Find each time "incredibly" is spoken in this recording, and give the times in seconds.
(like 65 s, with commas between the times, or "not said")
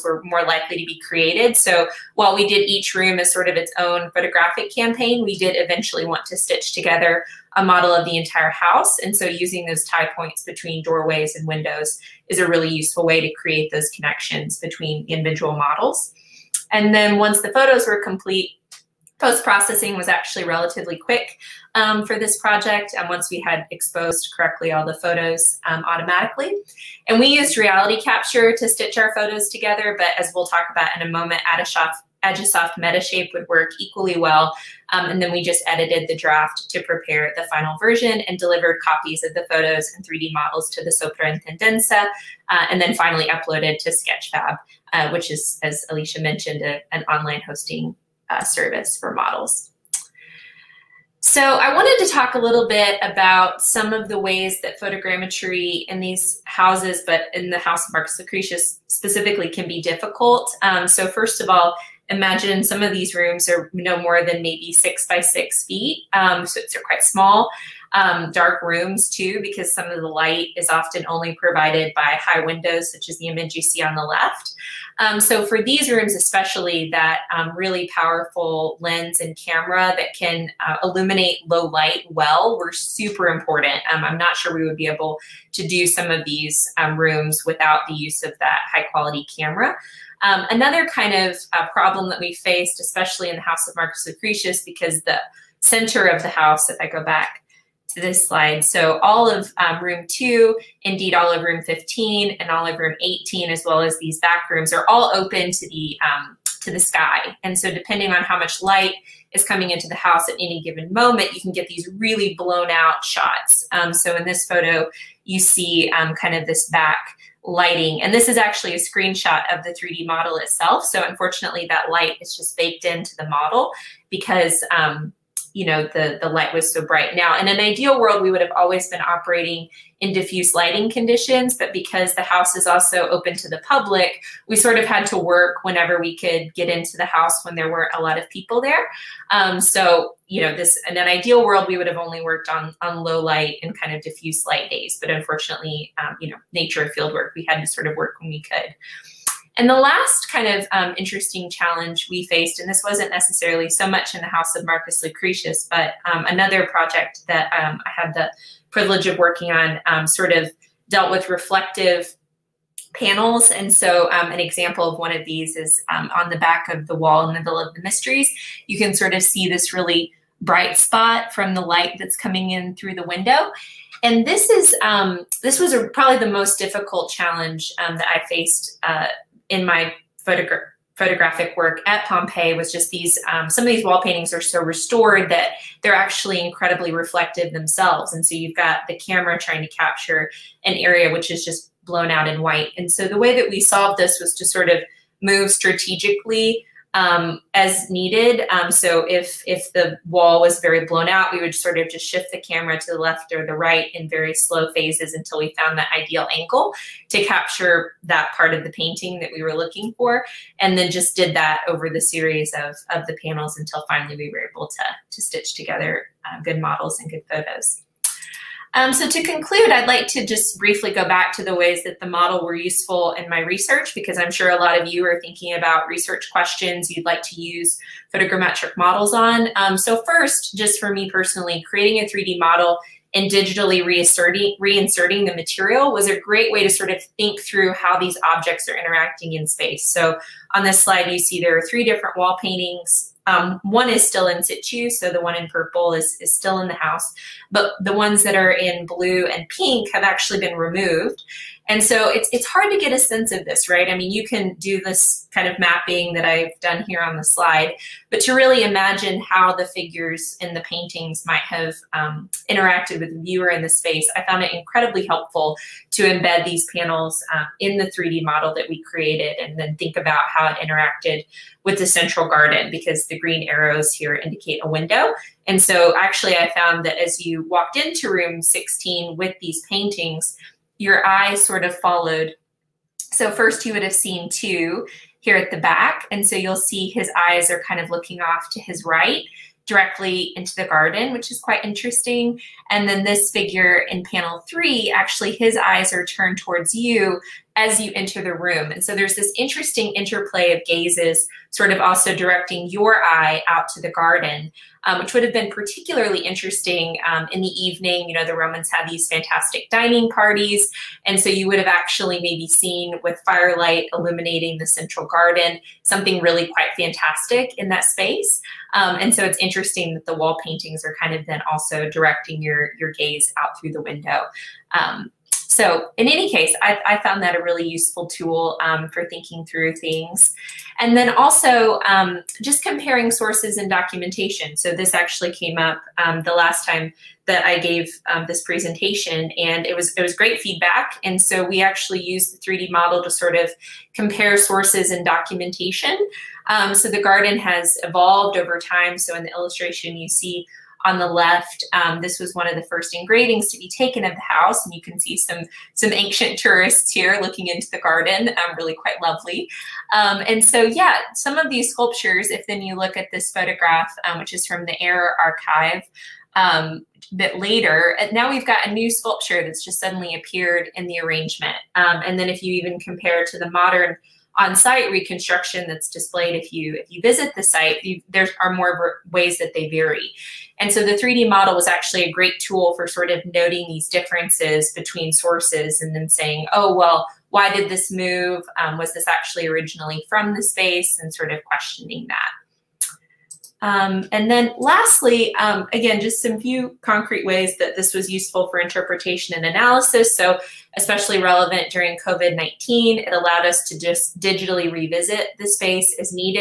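186 s, 264 s.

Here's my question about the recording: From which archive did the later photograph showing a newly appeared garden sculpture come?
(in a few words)
Air Archive.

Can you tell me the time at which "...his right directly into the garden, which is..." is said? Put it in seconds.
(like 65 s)
288 s.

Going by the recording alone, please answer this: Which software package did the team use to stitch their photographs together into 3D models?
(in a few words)
RealityCapture.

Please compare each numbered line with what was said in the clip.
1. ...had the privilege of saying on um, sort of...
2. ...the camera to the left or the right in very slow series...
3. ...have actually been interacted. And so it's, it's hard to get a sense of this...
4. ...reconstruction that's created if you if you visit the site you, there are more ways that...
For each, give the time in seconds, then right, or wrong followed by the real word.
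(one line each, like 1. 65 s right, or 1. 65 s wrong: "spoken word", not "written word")
1. 157 s wrong: "working", not "saying"
2. 202 s wrong: "phases", not "series"
3. 249 s wrong: "removed", not "interacted"
4. 374 s wrong: "displayed", not "created".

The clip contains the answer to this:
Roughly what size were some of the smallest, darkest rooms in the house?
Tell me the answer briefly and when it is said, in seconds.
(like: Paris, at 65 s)
6 by 6 feet, at 64 s.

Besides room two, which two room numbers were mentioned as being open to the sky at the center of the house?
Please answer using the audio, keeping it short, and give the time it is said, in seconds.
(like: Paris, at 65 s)
15 and 18, at 101 s.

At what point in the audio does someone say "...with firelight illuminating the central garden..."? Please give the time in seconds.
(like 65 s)
313 s.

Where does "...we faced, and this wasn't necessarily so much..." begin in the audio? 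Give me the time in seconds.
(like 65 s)
152 s.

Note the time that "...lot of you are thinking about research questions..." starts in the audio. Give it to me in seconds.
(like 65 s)
224 s.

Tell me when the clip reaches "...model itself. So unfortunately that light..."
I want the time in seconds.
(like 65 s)
120 s.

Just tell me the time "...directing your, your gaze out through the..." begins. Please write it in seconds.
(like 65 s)
321 s.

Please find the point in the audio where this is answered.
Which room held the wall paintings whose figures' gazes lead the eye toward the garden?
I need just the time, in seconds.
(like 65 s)
278 s.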